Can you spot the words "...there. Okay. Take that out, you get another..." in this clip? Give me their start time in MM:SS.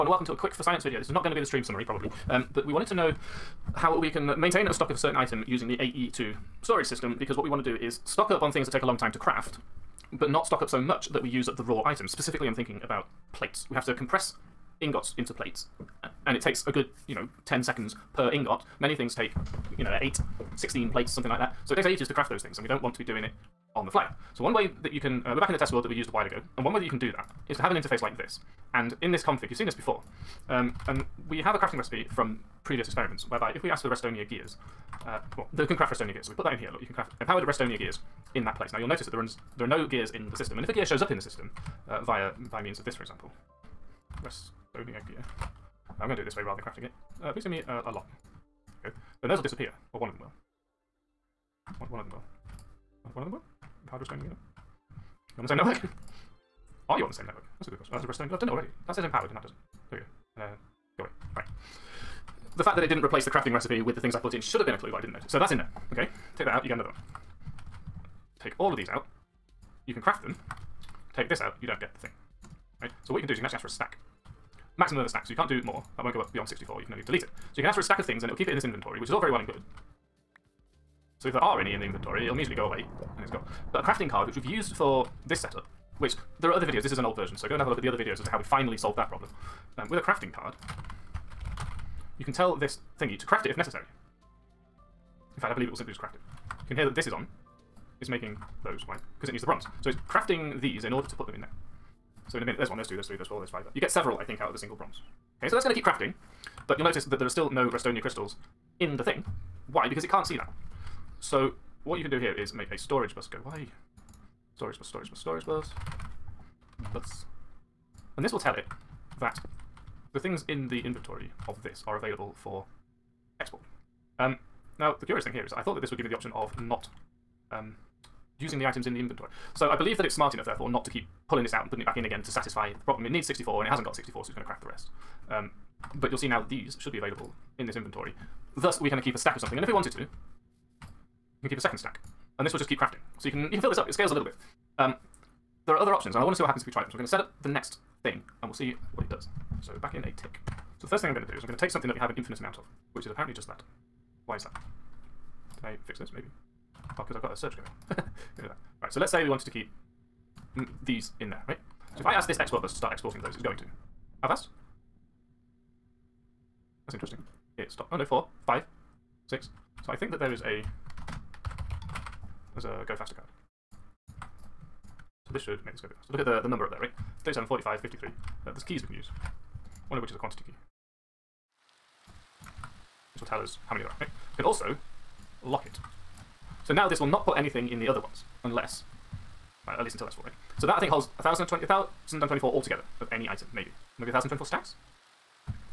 01:05.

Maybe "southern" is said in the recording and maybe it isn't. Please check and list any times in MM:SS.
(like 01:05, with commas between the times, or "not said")
not said.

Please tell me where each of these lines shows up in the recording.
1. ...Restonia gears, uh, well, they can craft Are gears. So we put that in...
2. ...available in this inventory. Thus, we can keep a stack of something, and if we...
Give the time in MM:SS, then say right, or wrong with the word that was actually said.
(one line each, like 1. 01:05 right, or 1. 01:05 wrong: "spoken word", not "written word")
1. 00:33 wrong: "Restonia", not "Are"
2. 02:16 right.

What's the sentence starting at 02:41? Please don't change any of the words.
So if I ask this export bus to start exporting those, it's going to.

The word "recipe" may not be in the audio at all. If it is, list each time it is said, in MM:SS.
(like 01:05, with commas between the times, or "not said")
00:31, 01:03.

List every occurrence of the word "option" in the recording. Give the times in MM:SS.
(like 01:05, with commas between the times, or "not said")
02:06, 02:25.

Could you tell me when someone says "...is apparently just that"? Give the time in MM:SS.
02:33.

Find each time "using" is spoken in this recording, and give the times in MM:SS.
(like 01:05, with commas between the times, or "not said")
00:05, 02:08.